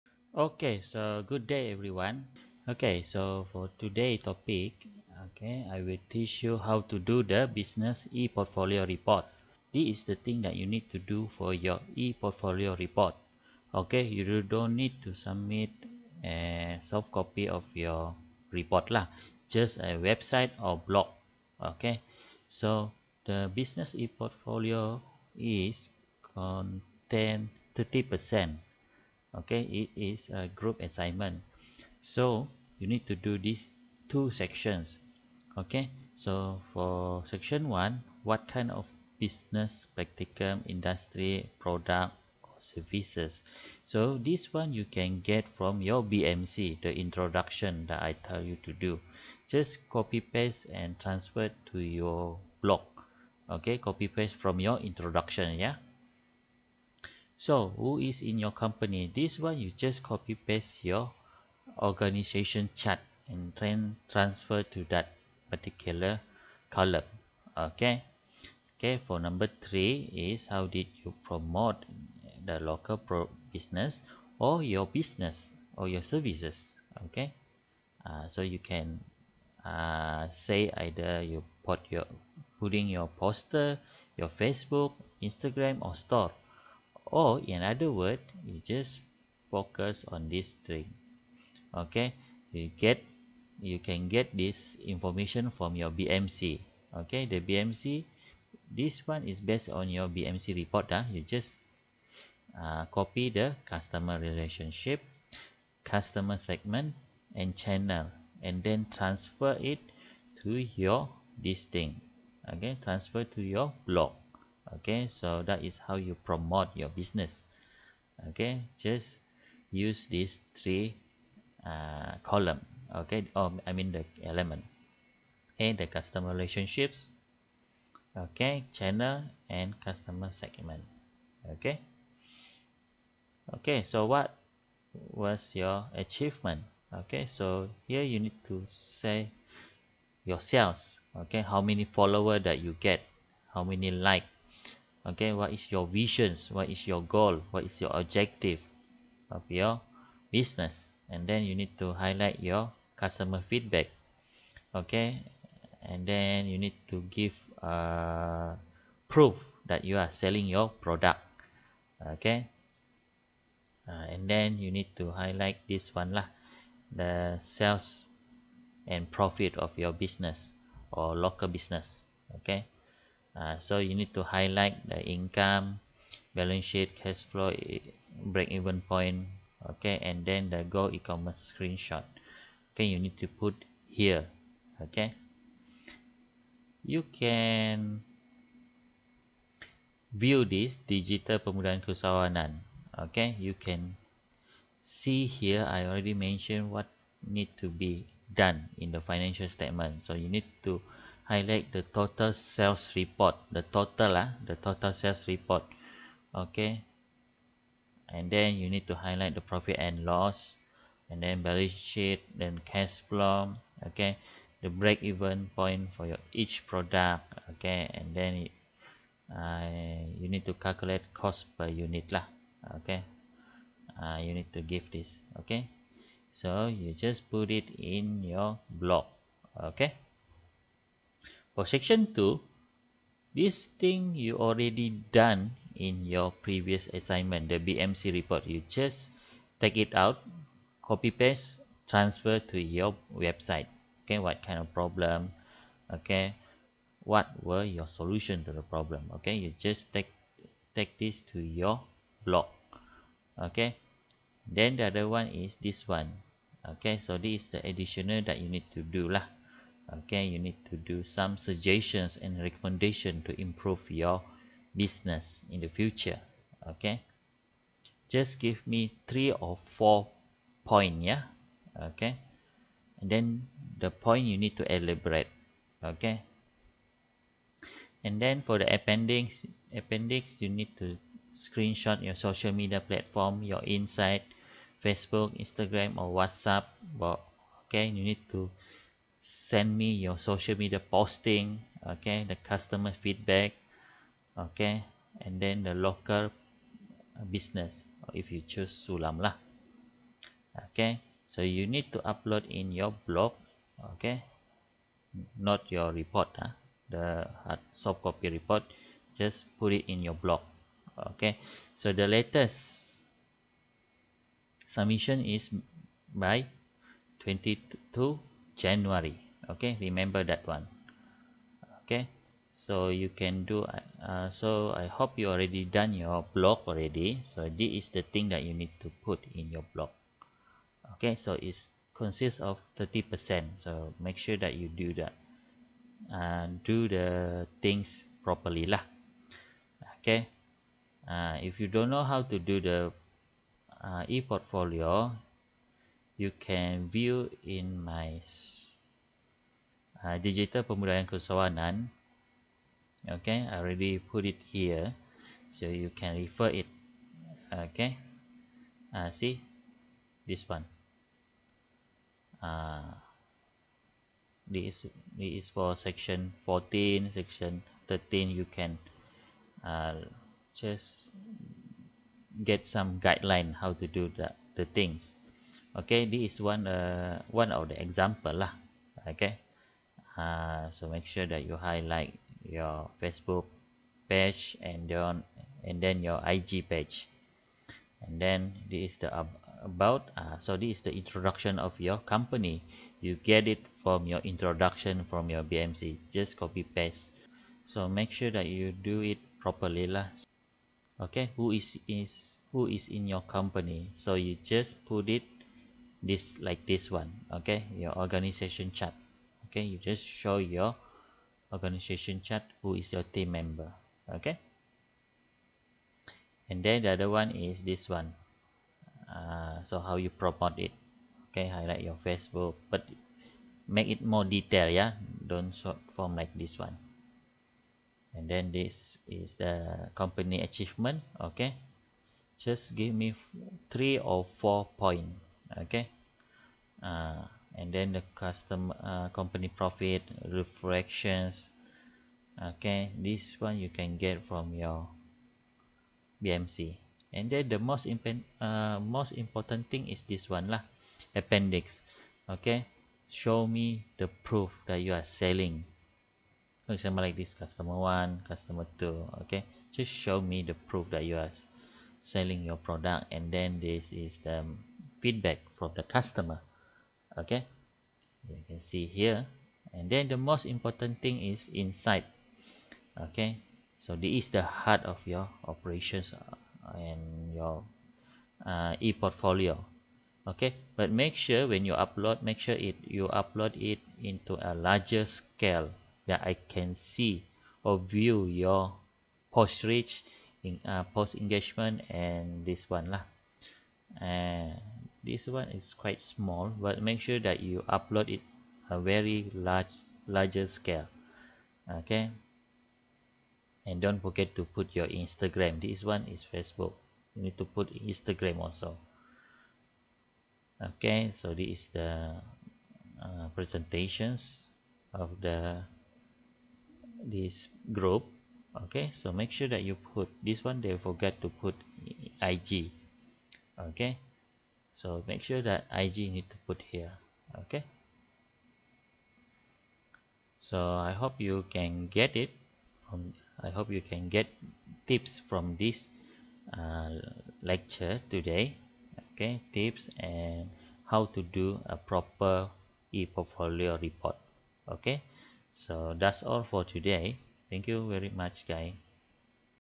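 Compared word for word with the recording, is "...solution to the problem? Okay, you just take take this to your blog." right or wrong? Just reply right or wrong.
right.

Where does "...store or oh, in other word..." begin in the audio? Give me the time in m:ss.
1:25.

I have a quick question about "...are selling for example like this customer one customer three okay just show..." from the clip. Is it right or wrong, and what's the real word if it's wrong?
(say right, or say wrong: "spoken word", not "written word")
wrong: "two", not "three".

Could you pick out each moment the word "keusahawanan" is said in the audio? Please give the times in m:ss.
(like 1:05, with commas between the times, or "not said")
3:11.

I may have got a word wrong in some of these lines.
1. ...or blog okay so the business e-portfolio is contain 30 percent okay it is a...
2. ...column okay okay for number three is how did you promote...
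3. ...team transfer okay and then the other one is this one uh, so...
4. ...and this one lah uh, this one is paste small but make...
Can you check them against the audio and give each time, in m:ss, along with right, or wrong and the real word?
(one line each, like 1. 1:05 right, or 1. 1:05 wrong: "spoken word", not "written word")
1. 0:20 right
2. 1:06 right
3. 6:53 wrong: "member", not "transfer"
4. 8:11 wrong: "quite", not "paste".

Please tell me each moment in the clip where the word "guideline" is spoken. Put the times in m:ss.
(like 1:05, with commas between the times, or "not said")
6:13.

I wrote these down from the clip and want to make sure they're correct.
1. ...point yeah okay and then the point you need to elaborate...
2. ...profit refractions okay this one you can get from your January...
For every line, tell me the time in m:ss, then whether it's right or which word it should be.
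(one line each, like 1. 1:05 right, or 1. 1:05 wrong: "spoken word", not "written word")
1. 4:30 right
2. 7:19 wrong: "BMC", not "January".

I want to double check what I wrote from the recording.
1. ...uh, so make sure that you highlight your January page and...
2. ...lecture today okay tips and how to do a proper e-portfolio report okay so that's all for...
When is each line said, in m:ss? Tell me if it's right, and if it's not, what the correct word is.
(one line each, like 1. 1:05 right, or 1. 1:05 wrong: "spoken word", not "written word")
1. 6:20 wrong: "Facebook", not "January"
2. 8:57 right.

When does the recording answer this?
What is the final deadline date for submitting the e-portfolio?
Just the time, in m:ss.
5:17.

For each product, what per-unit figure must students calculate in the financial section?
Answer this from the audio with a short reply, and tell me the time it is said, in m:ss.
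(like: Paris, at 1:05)
cost per unit, at 3:41.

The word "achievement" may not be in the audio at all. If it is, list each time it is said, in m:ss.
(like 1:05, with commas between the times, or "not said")
2:15, 7:10.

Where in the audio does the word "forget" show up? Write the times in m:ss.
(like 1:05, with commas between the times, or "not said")
8:24, 8:40.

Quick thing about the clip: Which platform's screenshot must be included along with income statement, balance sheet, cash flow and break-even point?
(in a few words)
Go e-commerce.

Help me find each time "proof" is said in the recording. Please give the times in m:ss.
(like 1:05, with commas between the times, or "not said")
2:39, 7:34, 7:40.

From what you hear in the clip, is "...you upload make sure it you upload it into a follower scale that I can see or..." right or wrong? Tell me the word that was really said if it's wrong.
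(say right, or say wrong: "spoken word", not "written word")
wrong: "larger", not "follower".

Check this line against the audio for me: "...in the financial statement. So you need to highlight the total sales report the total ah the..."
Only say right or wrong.
right.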